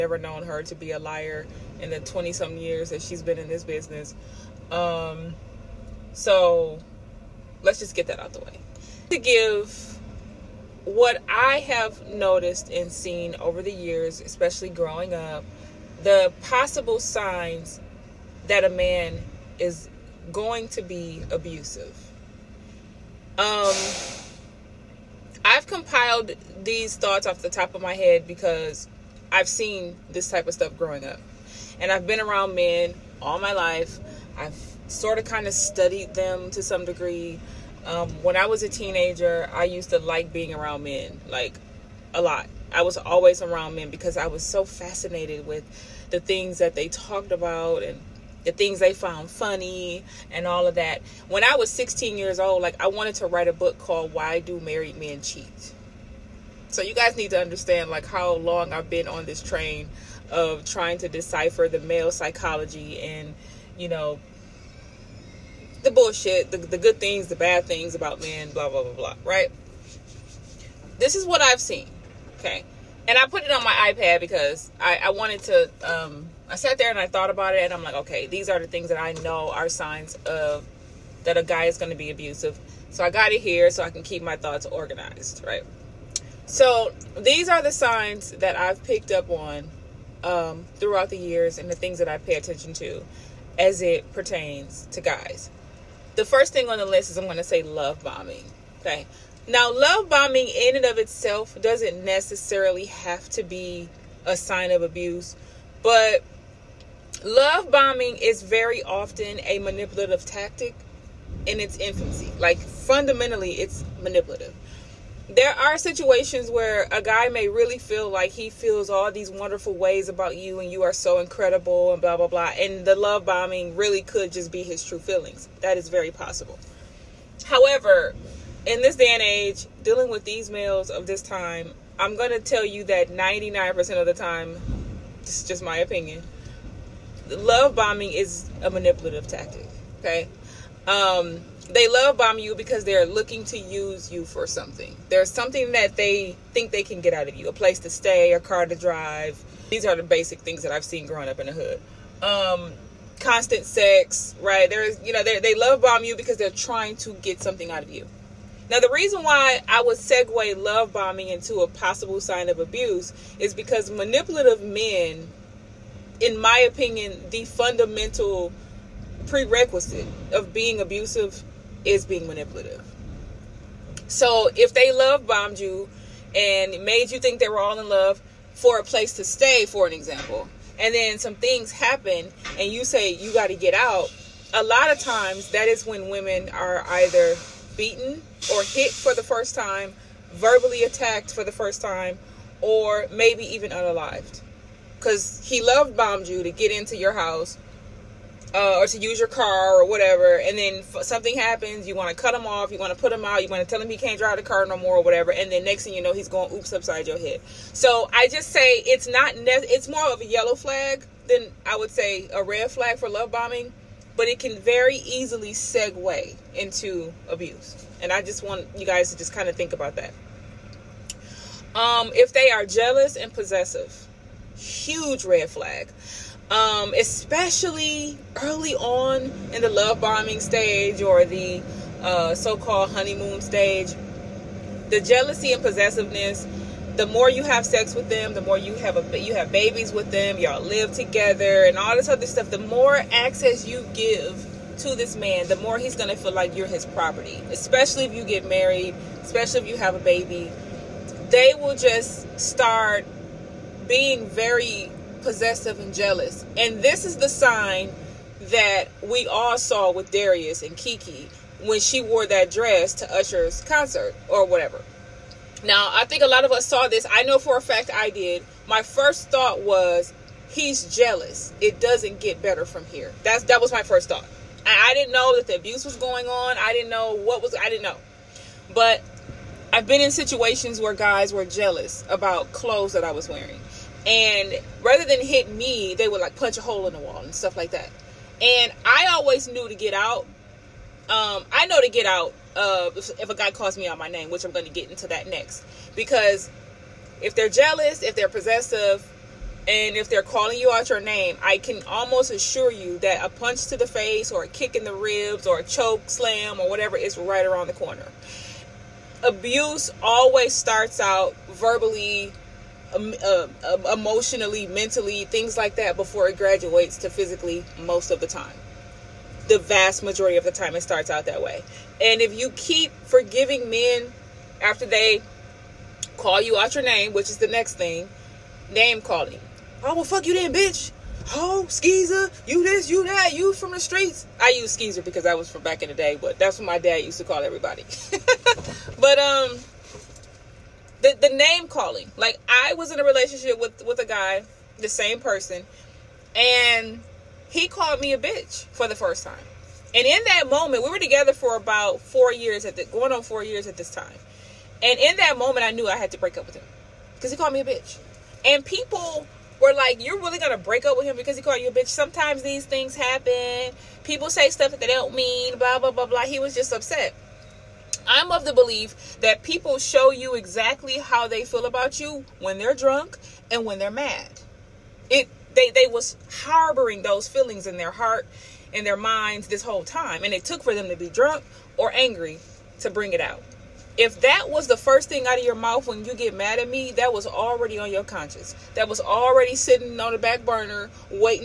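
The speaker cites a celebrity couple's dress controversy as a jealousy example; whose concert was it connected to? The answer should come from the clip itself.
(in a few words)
Usher.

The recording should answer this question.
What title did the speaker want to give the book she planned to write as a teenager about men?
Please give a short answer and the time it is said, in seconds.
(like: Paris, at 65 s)
Why Do Married Men Cheat?, at 54 s.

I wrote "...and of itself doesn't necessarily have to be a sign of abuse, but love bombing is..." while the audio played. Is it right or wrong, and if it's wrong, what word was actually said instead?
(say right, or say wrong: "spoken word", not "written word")
right.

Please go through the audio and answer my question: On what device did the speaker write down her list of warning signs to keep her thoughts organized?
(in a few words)
iPad.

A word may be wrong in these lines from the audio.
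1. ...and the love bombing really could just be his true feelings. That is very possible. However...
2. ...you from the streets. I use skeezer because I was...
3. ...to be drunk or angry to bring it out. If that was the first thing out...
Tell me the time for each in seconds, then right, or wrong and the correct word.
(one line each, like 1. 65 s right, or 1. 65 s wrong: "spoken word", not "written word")
1. 122 s right
2. 333 s right
3. 380 s right.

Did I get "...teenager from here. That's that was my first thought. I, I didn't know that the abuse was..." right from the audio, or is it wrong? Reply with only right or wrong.
wrong.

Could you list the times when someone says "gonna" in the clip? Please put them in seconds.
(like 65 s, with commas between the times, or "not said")
245 s, 360 s.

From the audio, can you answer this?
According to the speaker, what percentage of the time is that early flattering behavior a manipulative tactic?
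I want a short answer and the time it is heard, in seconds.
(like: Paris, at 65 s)
99%, at 133 s.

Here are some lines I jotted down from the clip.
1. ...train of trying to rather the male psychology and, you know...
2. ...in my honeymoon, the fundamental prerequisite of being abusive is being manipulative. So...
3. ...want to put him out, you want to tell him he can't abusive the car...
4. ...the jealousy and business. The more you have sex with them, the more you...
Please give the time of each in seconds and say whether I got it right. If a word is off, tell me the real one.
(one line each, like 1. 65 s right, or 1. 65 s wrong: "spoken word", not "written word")
1. 59 s wrong: "decipher", not "rather"
2. 166 s wrong: "opinion", not "honeymoon"
3. 202 s wrong: "drive", not "abusive"
4. 234 s wrong: "possessiveness", not "business".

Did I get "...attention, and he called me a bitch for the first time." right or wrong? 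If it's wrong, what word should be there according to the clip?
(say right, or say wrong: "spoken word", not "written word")
wrong: "person", not "attention".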